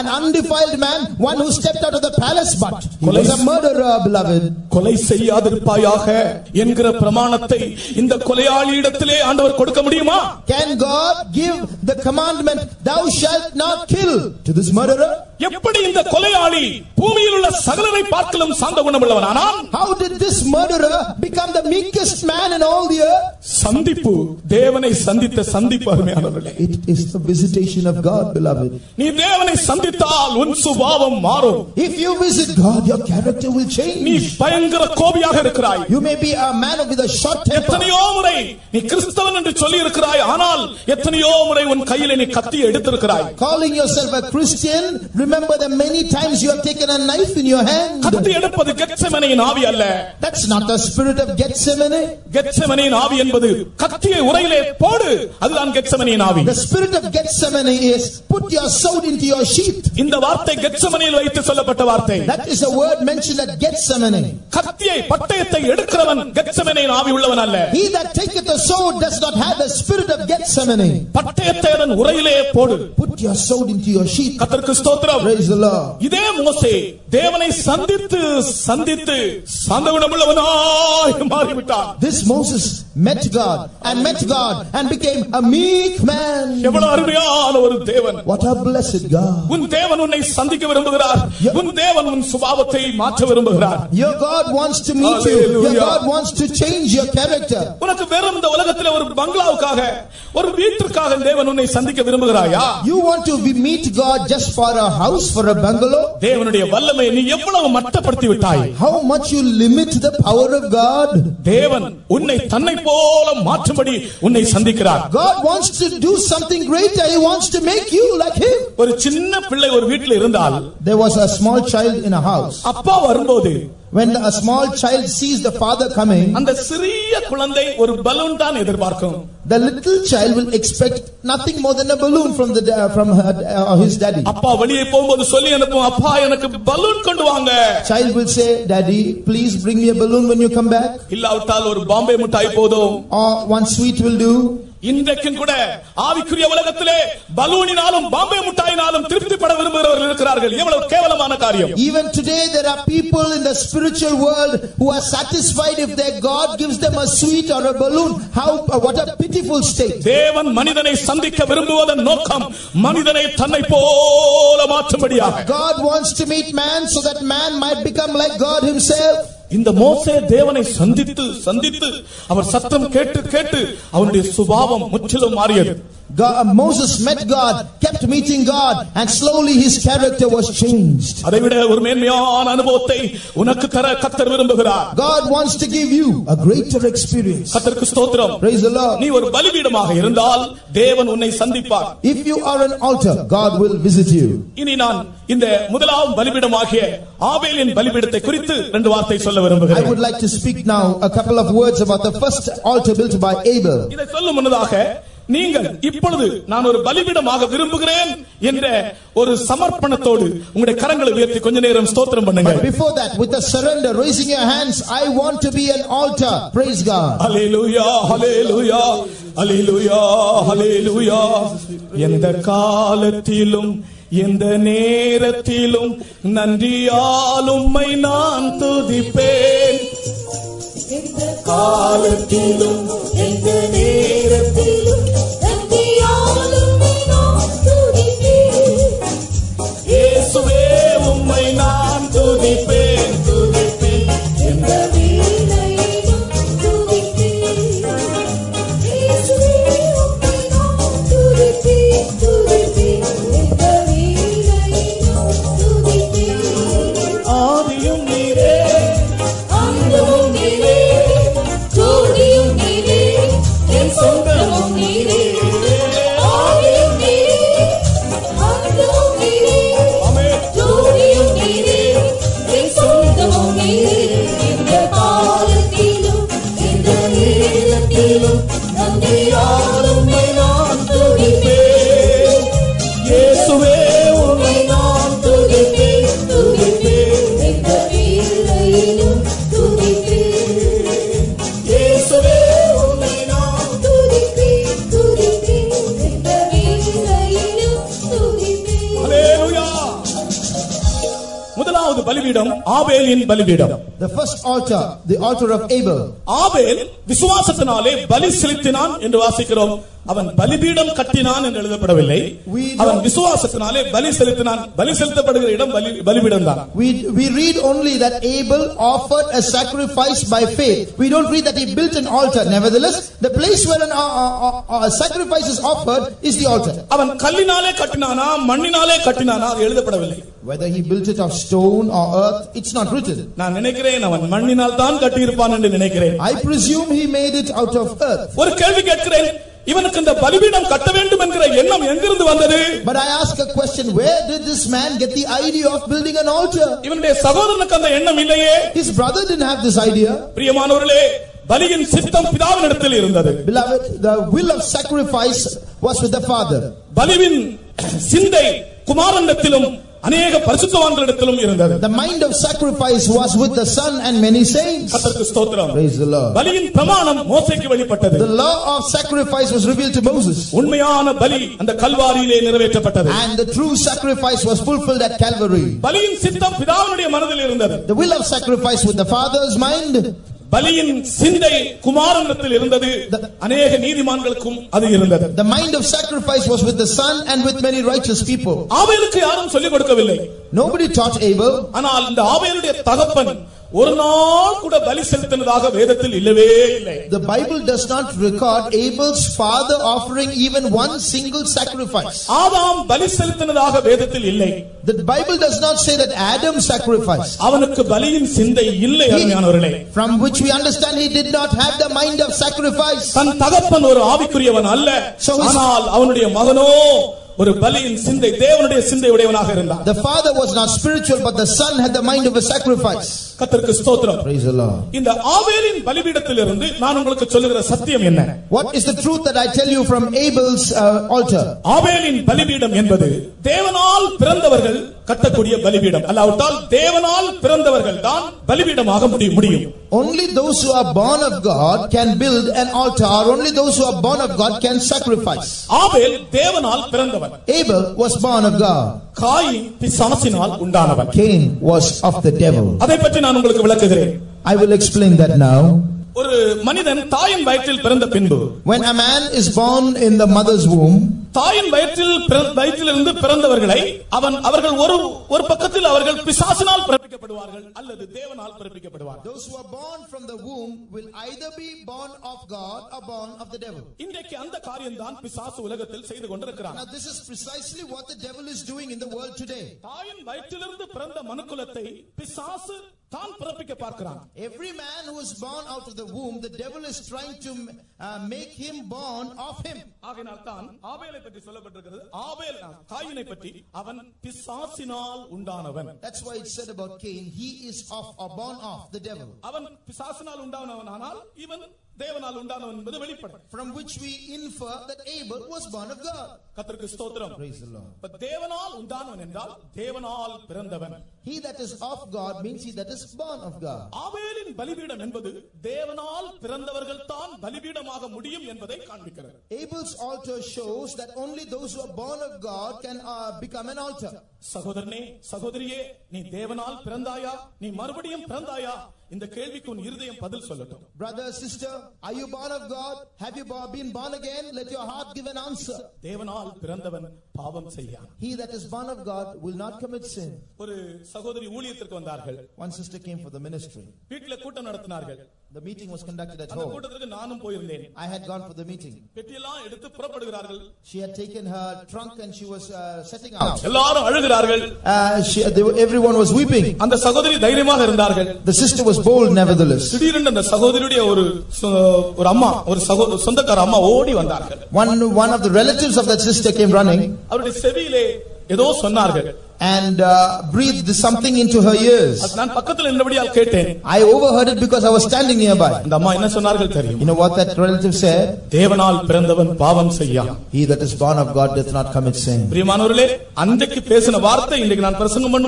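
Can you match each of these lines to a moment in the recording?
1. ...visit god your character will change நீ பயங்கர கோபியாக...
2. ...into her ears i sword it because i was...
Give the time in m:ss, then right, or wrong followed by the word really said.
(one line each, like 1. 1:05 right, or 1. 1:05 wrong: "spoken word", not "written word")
1. 0:32 right
2. 9:31 wrong: "overheard", not "sword".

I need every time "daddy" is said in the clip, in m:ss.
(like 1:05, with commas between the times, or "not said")
2:14, 2:18.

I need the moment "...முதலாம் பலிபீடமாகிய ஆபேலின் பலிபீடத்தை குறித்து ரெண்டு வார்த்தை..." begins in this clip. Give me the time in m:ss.
3:15.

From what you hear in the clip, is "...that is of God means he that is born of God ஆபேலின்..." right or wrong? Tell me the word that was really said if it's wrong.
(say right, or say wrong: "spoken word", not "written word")
right.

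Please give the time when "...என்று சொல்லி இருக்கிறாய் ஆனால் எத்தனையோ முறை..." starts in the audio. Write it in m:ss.
0:39.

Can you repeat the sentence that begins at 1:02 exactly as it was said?
That is a word mentioned at Gethsemane.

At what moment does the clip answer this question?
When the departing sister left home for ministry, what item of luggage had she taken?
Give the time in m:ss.
9:11.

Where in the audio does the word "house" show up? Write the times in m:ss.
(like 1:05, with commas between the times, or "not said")
1:45, 2:02.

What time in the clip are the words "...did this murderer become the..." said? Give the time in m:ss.
0:20.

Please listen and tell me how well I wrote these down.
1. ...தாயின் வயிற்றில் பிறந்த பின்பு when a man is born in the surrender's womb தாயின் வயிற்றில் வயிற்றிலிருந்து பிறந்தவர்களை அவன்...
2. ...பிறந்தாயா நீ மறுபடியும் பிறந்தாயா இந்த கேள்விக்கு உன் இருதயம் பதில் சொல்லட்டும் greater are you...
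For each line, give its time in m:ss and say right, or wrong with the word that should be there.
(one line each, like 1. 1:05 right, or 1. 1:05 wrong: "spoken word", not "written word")
1. 7:37 wrong: "mother", not "surrender"
2. 8:46 wrong: "sister", not "greater".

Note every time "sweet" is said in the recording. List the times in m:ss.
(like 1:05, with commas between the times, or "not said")
2:23, 2:37.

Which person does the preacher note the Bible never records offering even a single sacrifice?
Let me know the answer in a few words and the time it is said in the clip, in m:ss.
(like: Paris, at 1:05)
Adam, at 6:46.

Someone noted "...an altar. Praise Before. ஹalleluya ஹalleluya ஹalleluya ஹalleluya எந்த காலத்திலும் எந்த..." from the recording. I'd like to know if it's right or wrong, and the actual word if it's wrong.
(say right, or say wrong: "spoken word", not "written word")
wrong: "God", not "Before".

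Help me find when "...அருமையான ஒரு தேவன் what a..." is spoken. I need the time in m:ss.
1:26.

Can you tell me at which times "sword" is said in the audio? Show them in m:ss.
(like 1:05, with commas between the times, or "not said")
0:58, 1:08, 1:13.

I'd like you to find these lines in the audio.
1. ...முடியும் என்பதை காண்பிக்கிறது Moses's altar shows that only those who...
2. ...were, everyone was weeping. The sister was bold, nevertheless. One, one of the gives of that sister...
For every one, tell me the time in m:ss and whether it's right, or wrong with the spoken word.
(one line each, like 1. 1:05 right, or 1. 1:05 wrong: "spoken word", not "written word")
1. 8:38 wrong: "Abel", not "Moses"
2. 9:15 wrong: "relatives", not "gives".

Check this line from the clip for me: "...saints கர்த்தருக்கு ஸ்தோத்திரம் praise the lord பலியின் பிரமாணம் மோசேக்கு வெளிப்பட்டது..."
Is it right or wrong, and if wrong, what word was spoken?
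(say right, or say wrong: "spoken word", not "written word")
right.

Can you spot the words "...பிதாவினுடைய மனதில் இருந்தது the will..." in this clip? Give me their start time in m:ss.
6:16.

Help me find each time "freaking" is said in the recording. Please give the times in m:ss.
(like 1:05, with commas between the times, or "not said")
not said.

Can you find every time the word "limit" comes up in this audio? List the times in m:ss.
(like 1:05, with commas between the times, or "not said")
1:49.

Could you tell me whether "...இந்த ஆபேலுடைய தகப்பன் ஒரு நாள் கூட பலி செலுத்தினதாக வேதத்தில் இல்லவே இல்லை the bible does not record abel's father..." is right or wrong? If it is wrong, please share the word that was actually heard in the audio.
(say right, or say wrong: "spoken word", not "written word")
right.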